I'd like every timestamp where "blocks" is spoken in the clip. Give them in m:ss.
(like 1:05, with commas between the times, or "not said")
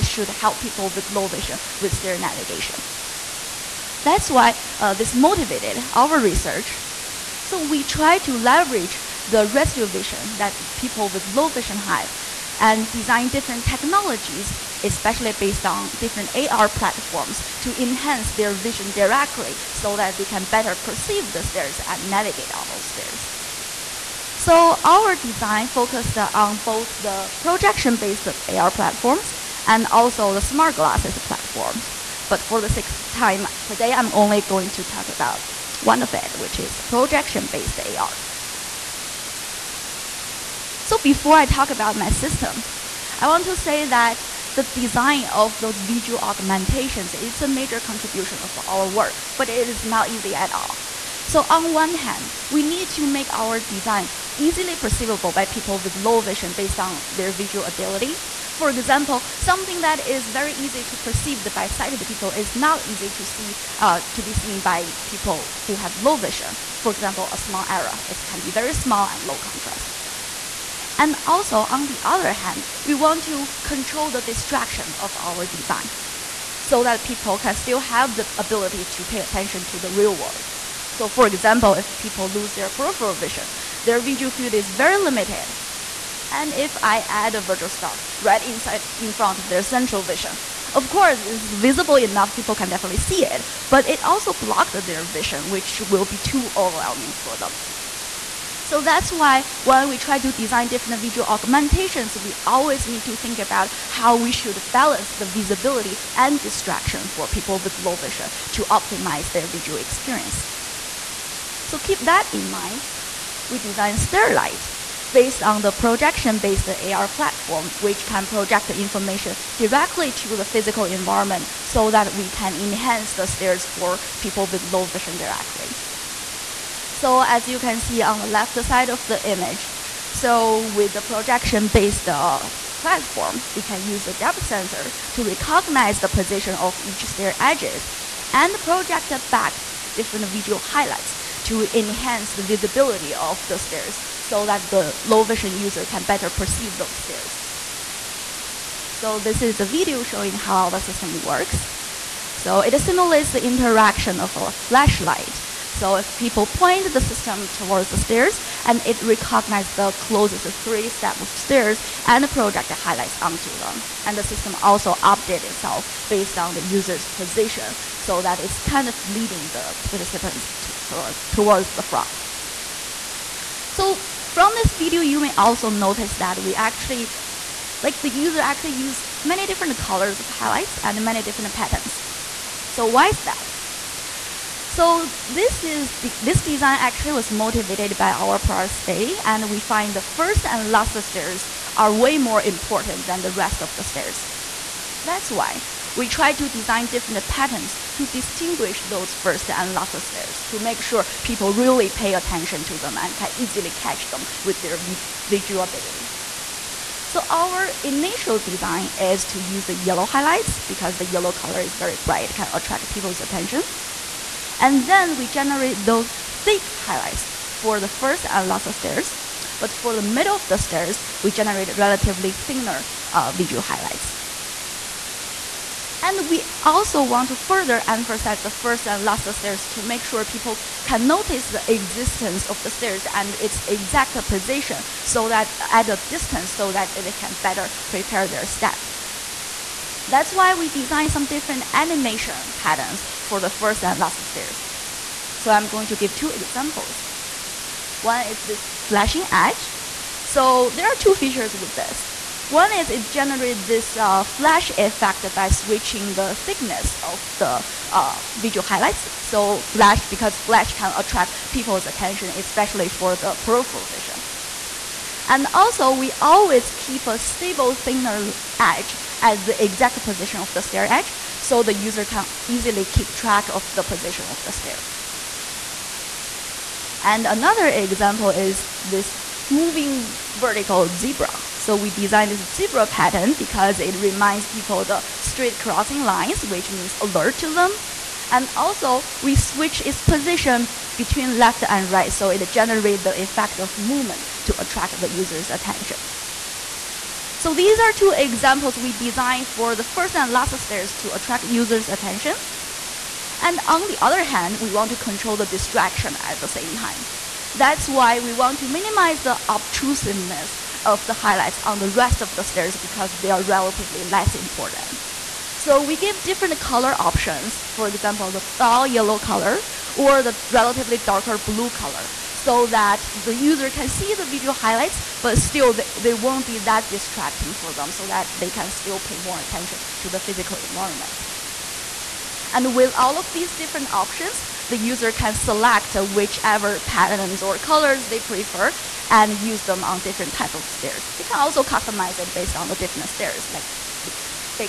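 1:34.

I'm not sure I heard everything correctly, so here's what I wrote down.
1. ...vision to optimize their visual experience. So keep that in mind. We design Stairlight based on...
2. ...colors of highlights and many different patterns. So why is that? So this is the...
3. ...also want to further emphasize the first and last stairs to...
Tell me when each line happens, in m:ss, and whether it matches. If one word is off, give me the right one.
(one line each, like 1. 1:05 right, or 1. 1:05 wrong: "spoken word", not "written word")
1. 1:47 right
2. 2:59 right
3. 3:46 right.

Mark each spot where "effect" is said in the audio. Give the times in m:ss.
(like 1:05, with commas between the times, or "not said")
4:14, 4:53.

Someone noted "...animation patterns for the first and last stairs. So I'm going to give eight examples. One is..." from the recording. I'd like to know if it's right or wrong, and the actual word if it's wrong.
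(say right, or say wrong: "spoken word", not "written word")
wrong: "two", not "eight".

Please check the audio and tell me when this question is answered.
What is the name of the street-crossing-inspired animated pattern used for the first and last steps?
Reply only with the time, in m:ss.
4:39.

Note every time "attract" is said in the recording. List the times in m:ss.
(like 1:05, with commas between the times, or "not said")
3:32, 4:20, 4:54, 5:01.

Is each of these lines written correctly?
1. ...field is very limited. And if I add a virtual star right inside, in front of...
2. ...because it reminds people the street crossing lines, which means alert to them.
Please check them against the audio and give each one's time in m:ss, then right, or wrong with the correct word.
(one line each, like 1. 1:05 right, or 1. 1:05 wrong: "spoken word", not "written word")
1. 1:24 right
2. 4:43 right.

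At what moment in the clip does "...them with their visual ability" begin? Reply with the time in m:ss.
3:24.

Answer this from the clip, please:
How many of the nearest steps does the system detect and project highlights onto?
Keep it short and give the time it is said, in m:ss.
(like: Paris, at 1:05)
3, at 2:40.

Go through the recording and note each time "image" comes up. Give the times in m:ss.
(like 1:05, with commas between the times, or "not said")
2:09.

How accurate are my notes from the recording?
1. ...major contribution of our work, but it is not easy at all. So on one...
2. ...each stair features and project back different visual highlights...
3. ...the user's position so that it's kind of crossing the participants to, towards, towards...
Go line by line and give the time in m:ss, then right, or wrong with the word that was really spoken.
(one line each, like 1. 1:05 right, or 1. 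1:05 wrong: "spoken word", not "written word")
1. 0:47 right
2. 2:16 wrong: "edges", not "features"
3. 2:46 wrong: "leading", not "crossing".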